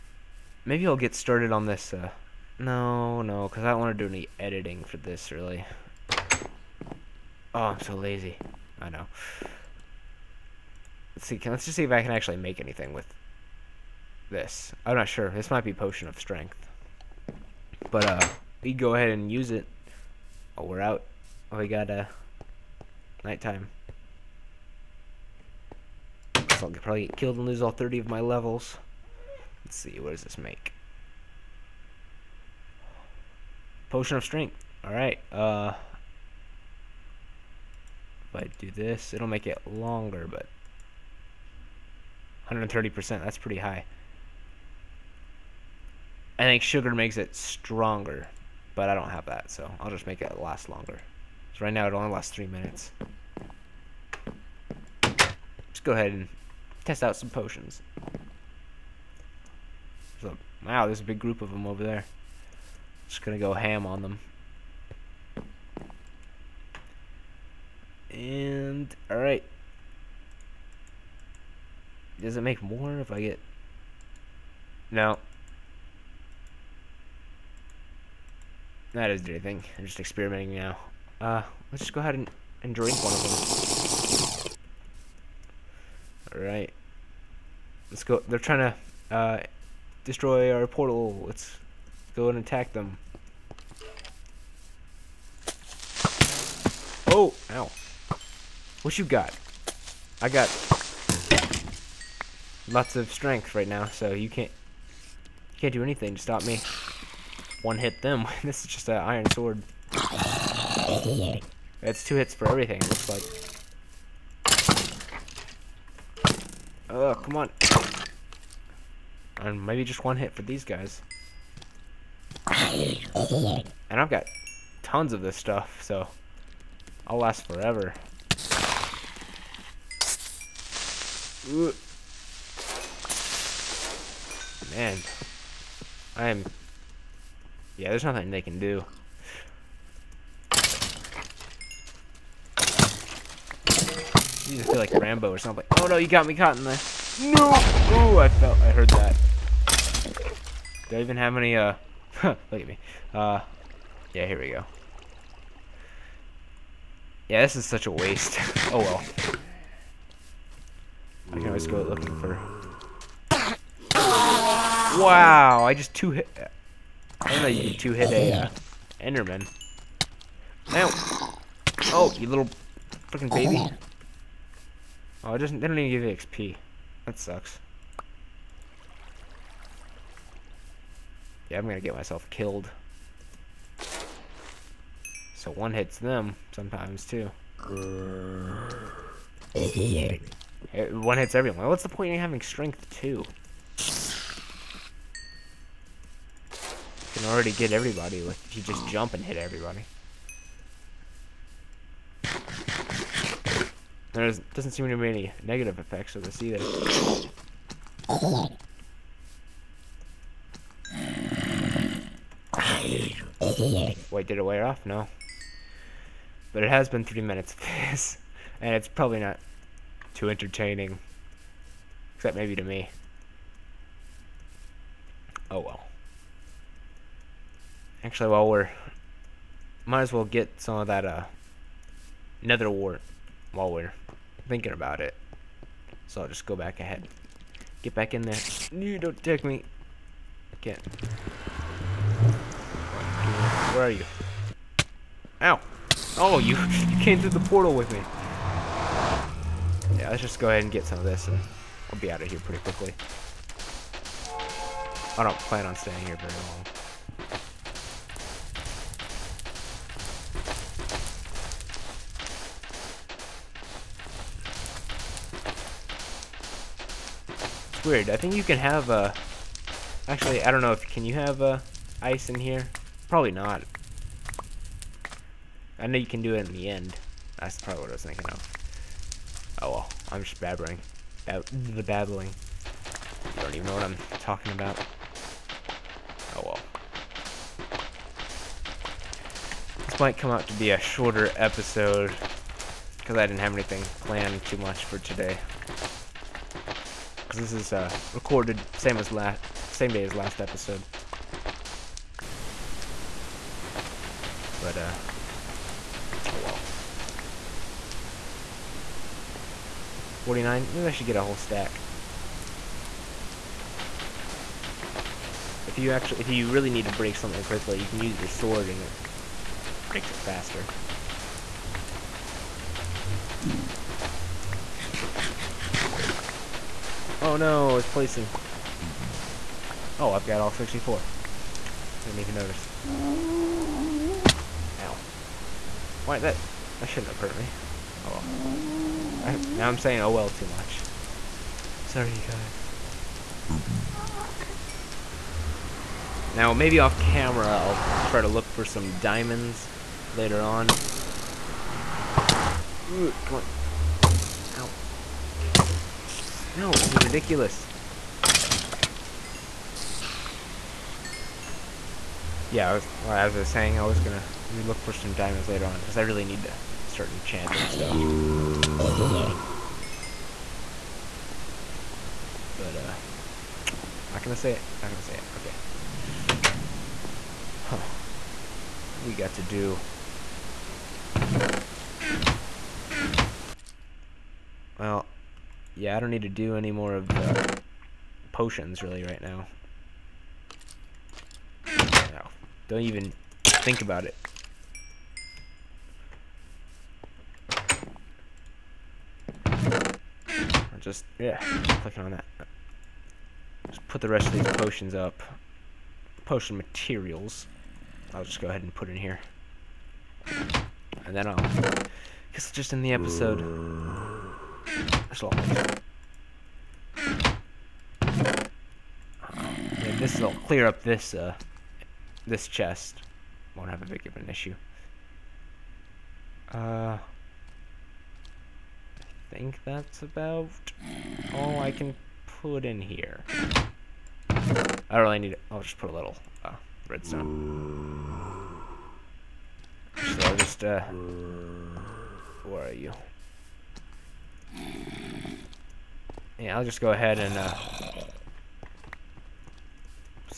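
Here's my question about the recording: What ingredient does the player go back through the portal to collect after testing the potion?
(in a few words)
Nether wart.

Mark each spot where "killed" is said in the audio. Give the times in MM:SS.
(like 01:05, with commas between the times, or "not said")
00:27, 03:02.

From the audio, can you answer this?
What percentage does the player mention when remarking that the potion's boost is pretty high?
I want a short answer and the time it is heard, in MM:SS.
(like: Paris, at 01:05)
130%, at 00:42.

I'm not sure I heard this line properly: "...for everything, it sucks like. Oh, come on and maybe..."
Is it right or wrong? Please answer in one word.
wrong.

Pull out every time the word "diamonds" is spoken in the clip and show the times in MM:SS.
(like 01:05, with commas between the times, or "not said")
05:48, 06:05.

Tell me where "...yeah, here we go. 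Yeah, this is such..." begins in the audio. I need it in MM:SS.
02:34.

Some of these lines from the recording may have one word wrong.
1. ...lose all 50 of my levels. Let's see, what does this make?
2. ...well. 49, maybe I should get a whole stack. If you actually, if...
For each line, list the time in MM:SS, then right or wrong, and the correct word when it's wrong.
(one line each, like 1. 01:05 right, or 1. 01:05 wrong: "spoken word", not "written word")
1. 00:27 wrong: "30", not "50"
2. 05:06 right.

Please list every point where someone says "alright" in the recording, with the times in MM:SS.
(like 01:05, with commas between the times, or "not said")
00:34, 01:09, 01:26.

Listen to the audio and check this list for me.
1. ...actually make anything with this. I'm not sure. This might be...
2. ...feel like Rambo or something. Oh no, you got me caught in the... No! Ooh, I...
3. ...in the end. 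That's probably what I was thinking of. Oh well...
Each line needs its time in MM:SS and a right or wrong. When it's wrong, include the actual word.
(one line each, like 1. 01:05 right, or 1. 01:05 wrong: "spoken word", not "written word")
1. 00:12 right
2. 02:24 right
3. 04:36 right.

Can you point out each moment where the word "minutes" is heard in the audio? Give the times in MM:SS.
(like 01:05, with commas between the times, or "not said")
00:52, 03:37.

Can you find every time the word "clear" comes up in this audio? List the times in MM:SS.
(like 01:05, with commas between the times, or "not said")
07:00.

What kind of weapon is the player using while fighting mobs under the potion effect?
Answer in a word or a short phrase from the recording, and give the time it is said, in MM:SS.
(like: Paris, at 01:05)
iron sword, at 01:48.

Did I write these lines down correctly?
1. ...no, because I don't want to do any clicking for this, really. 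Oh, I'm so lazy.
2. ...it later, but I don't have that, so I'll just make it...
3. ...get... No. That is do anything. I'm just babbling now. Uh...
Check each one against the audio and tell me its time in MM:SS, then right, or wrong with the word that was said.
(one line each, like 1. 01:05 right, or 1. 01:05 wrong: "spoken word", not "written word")
1. 00:03 wrong: "editing", not "clicking"
2. 00:47 wrong: "stronger", not "later"
3. 01:13 wrong: "experimenting", not "babbling".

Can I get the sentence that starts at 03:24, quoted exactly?
There doesn't seem to be any negative effects of this either.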